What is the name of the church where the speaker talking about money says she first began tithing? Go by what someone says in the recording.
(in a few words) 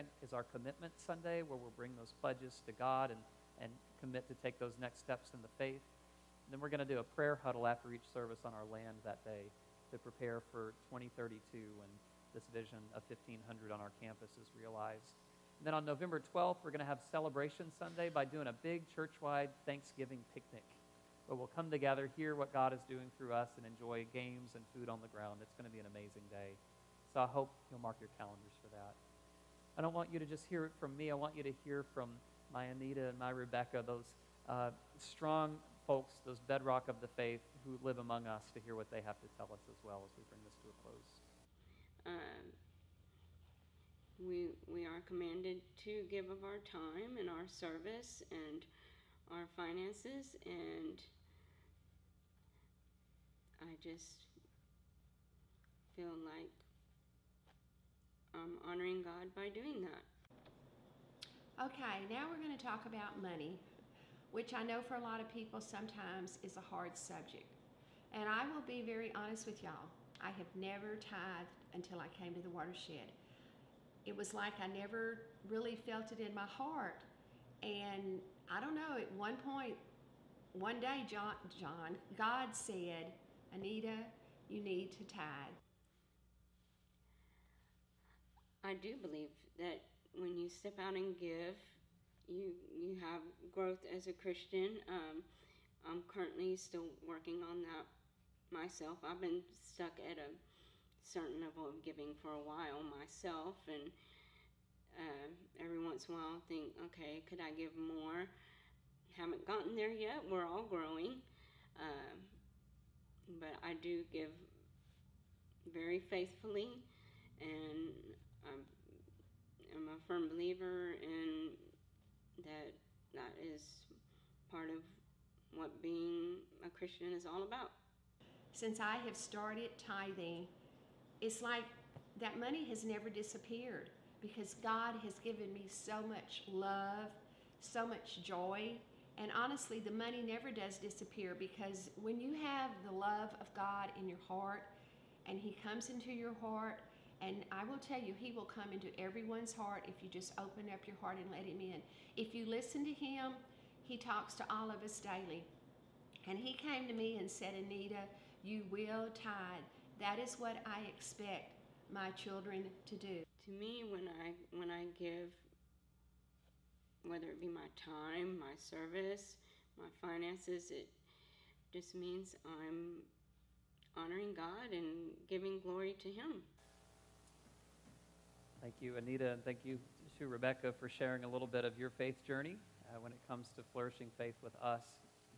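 The Watershed.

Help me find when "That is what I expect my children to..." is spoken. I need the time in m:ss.
2:39.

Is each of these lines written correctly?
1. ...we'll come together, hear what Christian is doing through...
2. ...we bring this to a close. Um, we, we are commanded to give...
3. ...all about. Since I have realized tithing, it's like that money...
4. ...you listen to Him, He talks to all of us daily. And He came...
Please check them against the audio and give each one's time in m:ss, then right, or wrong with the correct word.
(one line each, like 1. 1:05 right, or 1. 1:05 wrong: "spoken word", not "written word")
1. 0:21 wrong: "God", not "Christian"
2. 0:40 right
3. 2:07 wrong: "started", not "realized"
4. 2:32 right.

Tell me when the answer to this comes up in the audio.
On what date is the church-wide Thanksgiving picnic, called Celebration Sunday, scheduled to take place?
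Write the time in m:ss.
0:15.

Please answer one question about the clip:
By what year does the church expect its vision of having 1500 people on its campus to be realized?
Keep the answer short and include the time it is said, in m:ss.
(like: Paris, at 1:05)
2032, at 0:10.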